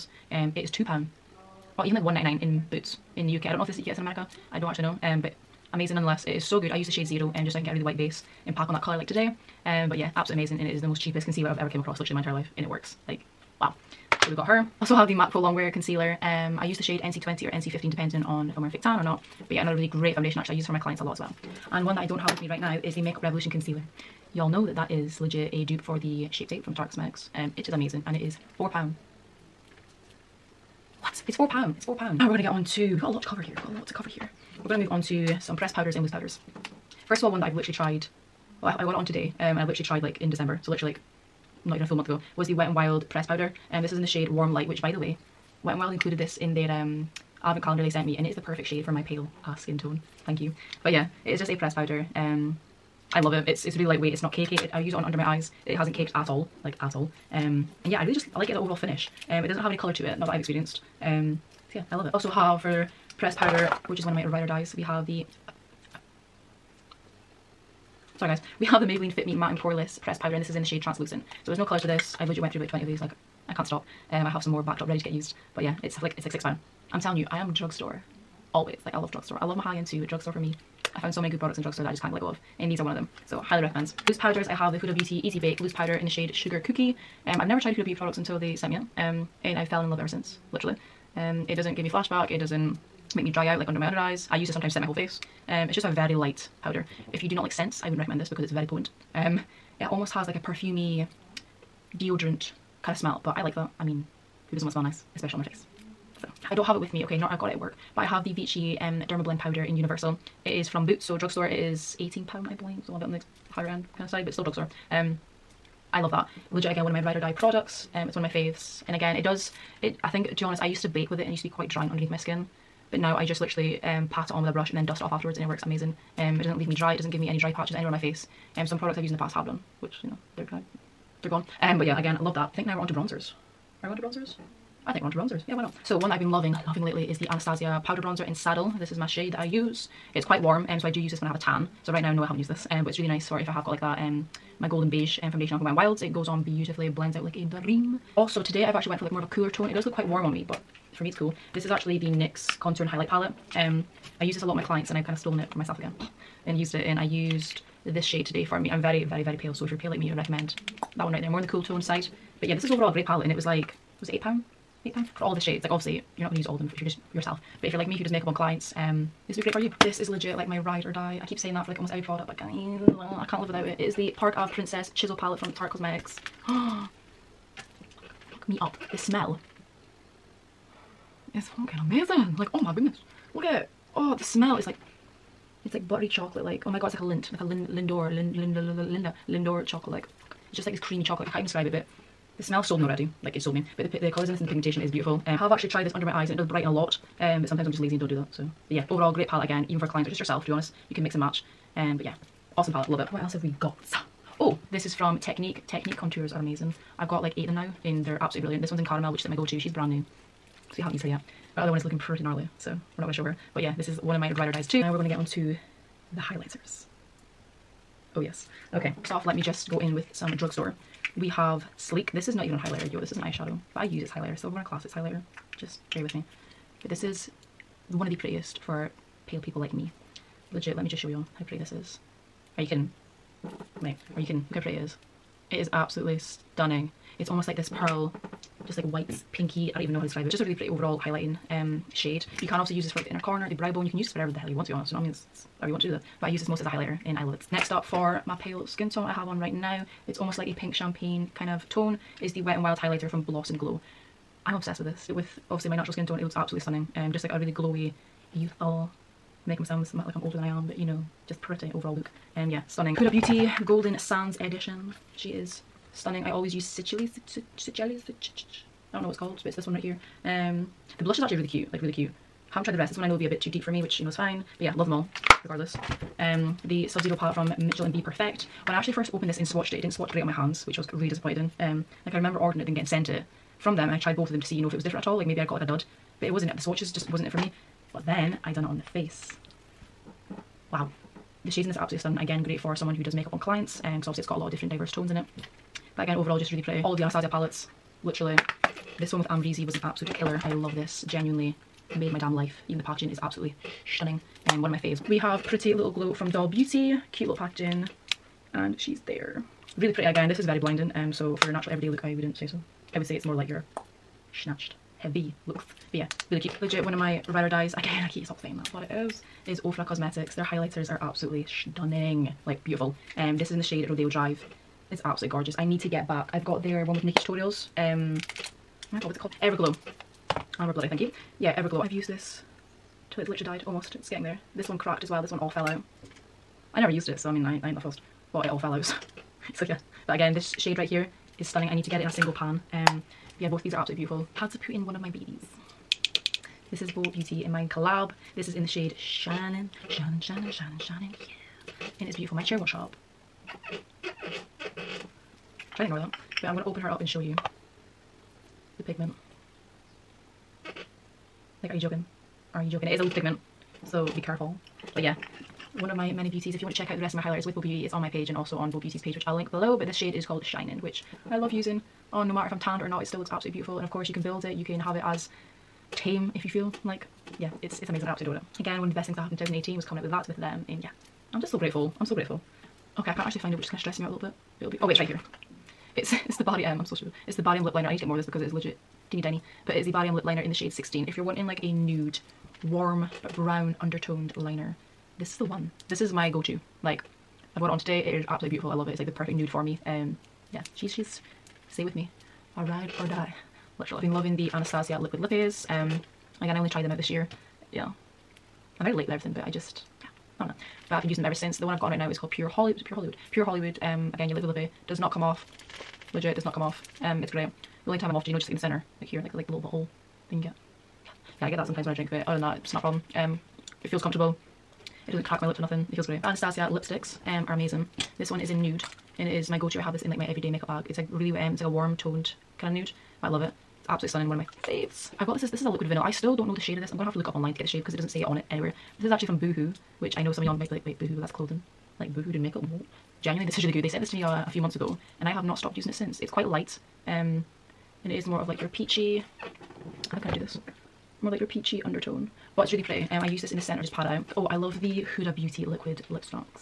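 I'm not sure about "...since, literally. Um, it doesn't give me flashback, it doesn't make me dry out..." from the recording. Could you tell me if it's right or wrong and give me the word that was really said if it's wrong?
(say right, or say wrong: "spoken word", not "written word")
right.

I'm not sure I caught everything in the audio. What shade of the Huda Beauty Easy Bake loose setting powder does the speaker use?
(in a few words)
Sugar Cookie.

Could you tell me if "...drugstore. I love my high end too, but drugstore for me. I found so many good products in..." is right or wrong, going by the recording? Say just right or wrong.
right.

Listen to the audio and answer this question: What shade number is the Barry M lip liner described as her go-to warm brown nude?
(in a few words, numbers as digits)
16.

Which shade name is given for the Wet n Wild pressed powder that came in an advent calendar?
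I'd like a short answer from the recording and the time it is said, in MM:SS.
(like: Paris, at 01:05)
Warm Light, at 00:44.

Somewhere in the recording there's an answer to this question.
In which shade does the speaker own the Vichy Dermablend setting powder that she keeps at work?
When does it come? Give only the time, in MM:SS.
01:49.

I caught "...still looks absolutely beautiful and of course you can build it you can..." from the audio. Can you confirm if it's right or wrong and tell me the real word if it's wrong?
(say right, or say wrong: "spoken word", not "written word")
right.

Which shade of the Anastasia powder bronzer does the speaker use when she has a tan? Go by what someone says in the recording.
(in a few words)
Saddle.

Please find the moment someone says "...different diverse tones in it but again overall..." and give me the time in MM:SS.
04:54.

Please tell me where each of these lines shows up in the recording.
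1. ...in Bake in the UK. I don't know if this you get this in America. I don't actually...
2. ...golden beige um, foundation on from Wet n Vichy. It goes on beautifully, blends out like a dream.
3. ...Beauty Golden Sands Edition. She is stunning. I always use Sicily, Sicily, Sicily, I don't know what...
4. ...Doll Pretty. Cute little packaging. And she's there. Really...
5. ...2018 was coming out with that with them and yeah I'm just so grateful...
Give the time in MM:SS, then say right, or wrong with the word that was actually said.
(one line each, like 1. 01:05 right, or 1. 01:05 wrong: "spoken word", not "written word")
1. 00:02 wrong: "Boots", not "Bake"
2. 02:24 wrong: "Wild", not "Vichy"
3. 04:23 right
4. 05:06 wrong: "Beauty", not "Pretty"
5. 06:19 right.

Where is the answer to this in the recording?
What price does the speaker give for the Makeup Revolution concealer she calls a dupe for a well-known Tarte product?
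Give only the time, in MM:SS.
00:28.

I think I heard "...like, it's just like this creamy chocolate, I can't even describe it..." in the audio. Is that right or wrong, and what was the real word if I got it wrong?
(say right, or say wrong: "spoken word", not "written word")
right.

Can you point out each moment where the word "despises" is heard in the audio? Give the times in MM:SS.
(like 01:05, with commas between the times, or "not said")
not said.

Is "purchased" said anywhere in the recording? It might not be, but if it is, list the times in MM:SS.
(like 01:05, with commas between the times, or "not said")
not said.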